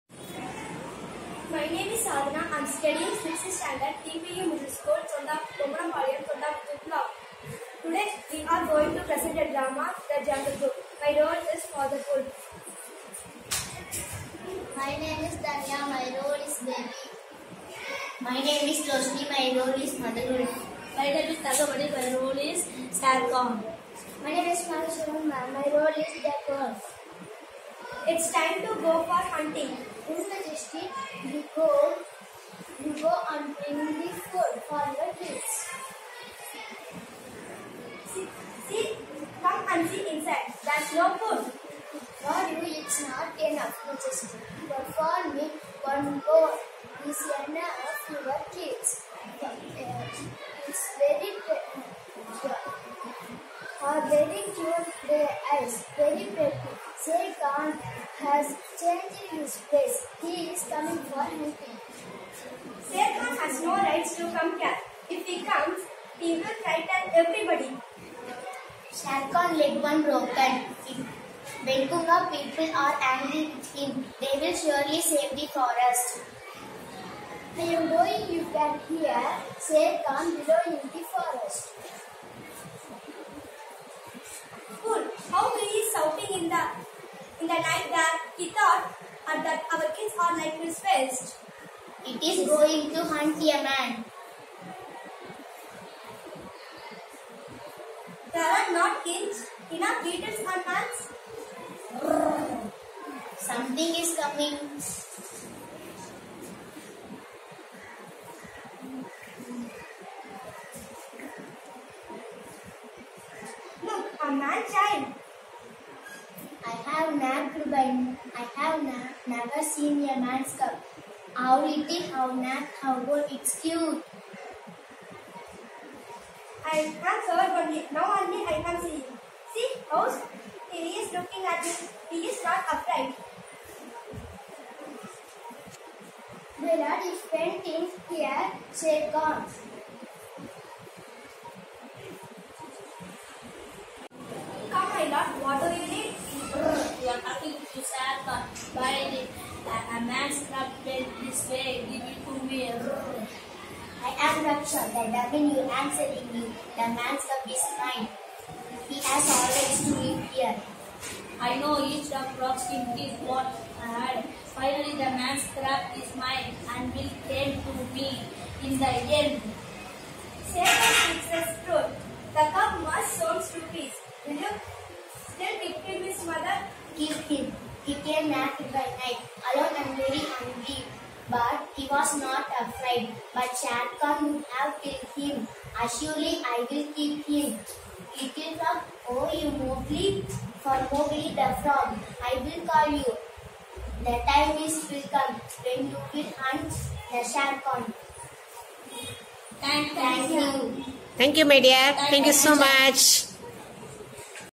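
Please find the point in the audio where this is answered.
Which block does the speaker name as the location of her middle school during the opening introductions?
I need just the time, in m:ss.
0:06.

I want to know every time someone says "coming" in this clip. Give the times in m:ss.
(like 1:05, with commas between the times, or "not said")
1:00, 1:44.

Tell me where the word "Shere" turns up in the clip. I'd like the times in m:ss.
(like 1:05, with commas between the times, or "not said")
0:57, 1:02, 1:08, 1:19, 3:03, 3:17.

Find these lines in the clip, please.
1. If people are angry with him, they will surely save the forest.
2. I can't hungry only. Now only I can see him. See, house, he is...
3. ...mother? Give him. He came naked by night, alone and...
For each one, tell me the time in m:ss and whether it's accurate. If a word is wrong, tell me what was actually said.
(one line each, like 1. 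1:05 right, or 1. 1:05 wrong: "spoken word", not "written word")
1. 1:10 right
2. 2:06 wrong: "sorry", not "hungry"
3. 2:56 right.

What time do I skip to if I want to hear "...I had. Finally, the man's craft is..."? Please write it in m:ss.
2:43.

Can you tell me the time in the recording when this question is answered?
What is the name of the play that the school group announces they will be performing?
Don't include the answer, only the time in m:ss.
0:10.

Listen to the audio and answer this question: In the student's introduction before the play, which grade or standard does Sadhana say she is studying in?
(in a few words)
6th standard.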